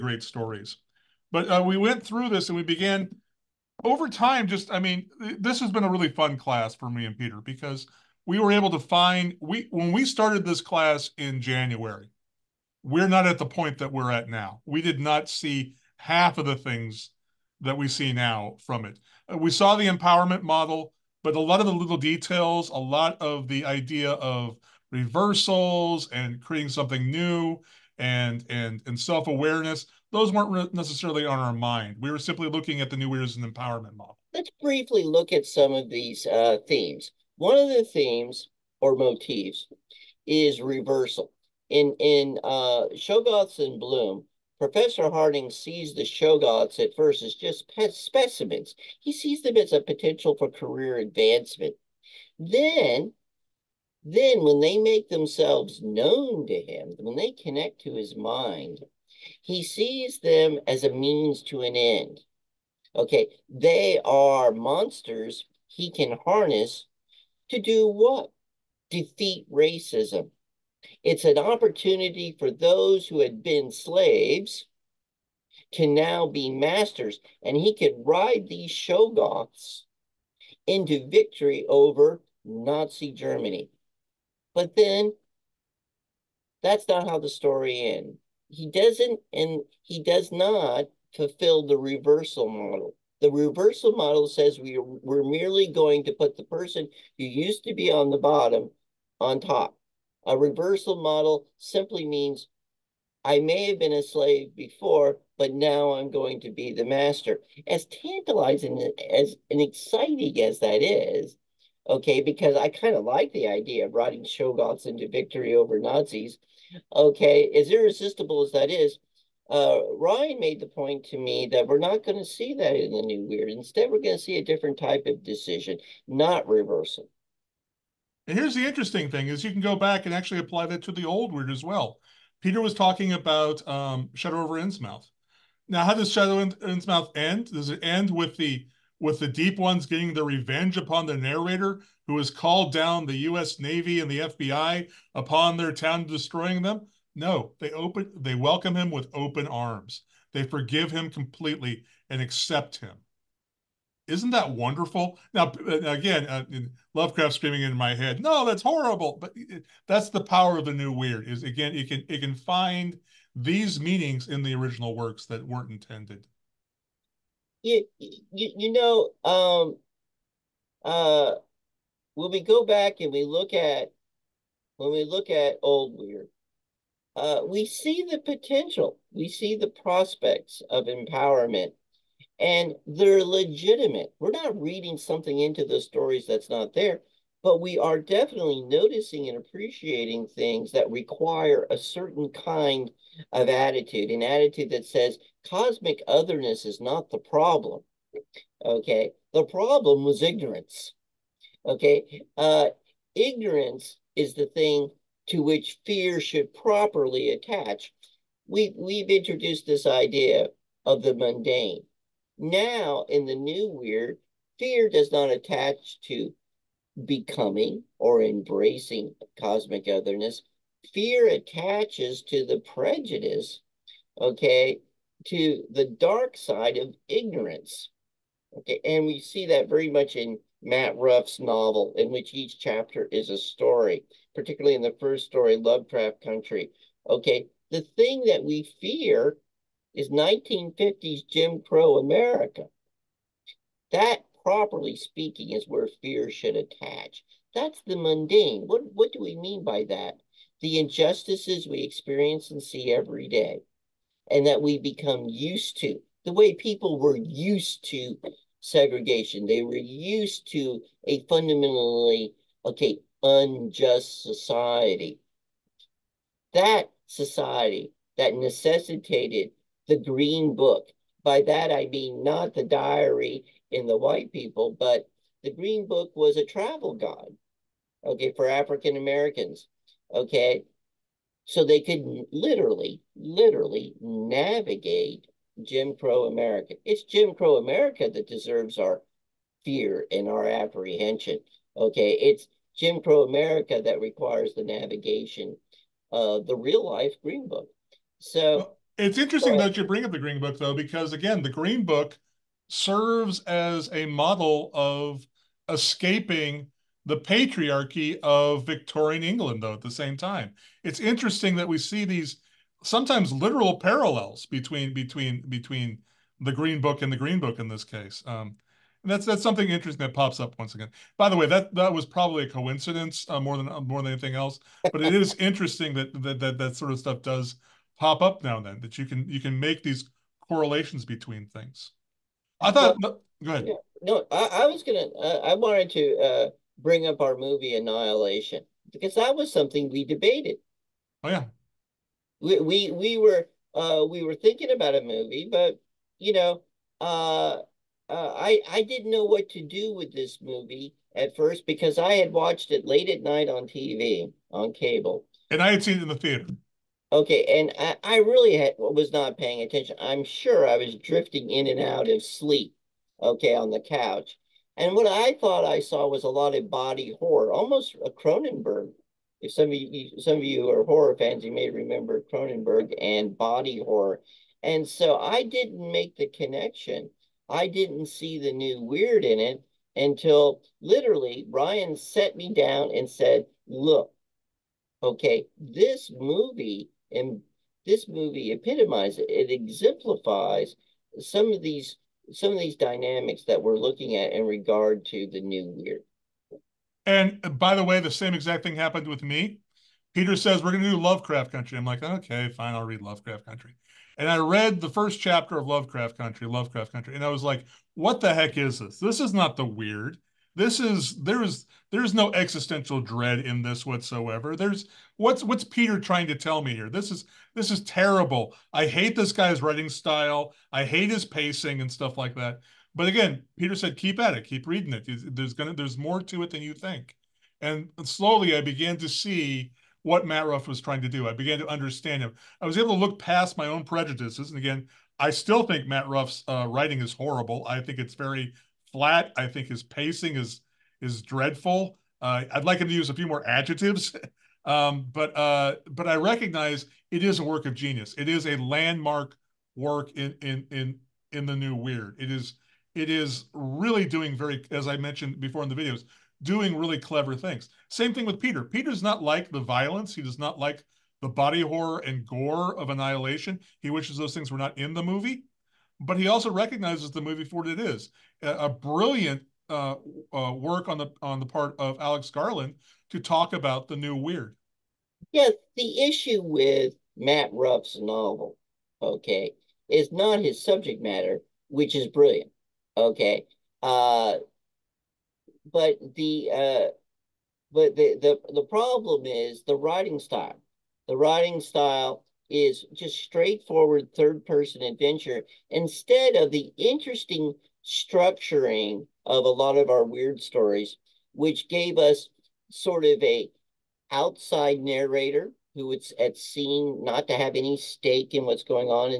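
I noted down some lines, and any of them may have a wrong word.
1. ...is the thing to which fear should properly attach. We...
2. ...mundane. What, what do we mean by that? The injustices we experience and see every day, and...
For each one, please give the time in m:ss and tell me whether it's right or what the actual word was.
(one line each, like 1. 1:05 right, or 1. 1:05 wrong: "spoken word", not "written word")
1. 3:24 right
2. 4:07 right.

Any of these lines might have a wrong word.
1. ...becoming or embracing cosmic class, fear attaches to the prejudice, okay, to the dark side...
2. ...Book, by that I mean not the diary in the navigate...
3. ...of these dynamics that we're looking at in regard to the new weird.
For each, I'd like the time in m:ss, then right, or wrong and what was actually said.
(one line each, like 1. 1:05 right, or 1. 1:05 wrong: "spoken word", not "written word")
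1. 3:37 wrong: "otherness", not "class"
2. 4:30 wrong: "white", not "navigate"
3. 6:32 right.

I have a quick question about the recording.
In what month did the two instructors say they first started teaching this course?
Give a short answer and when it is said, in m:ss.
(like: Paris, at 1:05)
January, at 0:11.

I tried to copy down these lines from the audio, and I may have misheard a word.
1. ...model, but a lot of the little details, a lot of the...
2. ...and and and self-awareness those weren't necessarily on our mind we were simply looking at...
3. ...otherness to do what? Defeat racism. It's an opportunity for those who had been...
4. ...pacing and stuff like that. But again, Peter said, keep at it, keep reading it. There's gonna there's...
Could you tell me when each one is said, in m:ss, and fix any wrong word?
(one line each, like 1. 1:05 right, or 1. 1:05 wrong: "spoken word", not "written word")
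1. 0:20 right
2. 0:27 right
3. 1:06 wrong: "harness", not "otherness"
4. 7:01 right.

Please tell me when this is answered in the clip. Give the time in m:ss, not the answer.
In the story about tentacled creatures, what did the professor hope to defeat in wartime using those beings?
1:22.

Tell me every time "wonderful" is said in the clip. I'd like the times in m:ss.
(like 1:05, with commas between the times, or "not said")
2:34.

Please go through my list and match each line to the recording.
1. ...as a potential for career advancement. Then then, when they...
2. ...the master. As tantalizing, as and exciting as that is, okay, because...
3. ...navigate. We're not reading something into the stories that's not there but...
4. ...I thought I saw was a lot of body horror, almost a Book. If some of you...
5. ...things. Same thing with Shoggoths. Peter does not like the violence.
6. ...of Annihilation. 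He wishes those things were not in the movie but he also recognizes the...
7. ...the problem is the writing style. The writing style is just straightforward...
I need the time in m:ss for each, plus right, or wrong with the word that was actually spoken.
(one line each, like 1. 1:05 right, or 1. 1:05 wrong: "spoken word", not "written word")
1. 0:49 right
2. 1:46 right
3. 3:03 wrong: "legitimate", not "navigate"
4. 6:05 wrong: "Cronenberg", not "Book"
5. 7:37 wrong: "Peter", not "Shoggoths"
6. 7:42 right
7. 8:08 right.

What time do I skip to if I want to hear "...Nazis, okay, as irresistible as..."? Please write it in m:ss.
1:55.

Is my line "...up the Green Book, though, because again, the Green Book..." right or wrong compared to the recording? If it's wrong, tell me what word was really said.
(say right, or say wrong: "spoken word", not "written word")
right.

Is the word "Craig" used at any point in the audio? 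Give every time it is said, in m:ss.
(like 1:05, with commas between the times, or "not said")
not said.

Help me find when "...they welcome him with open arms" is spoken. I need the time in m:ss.
2:28.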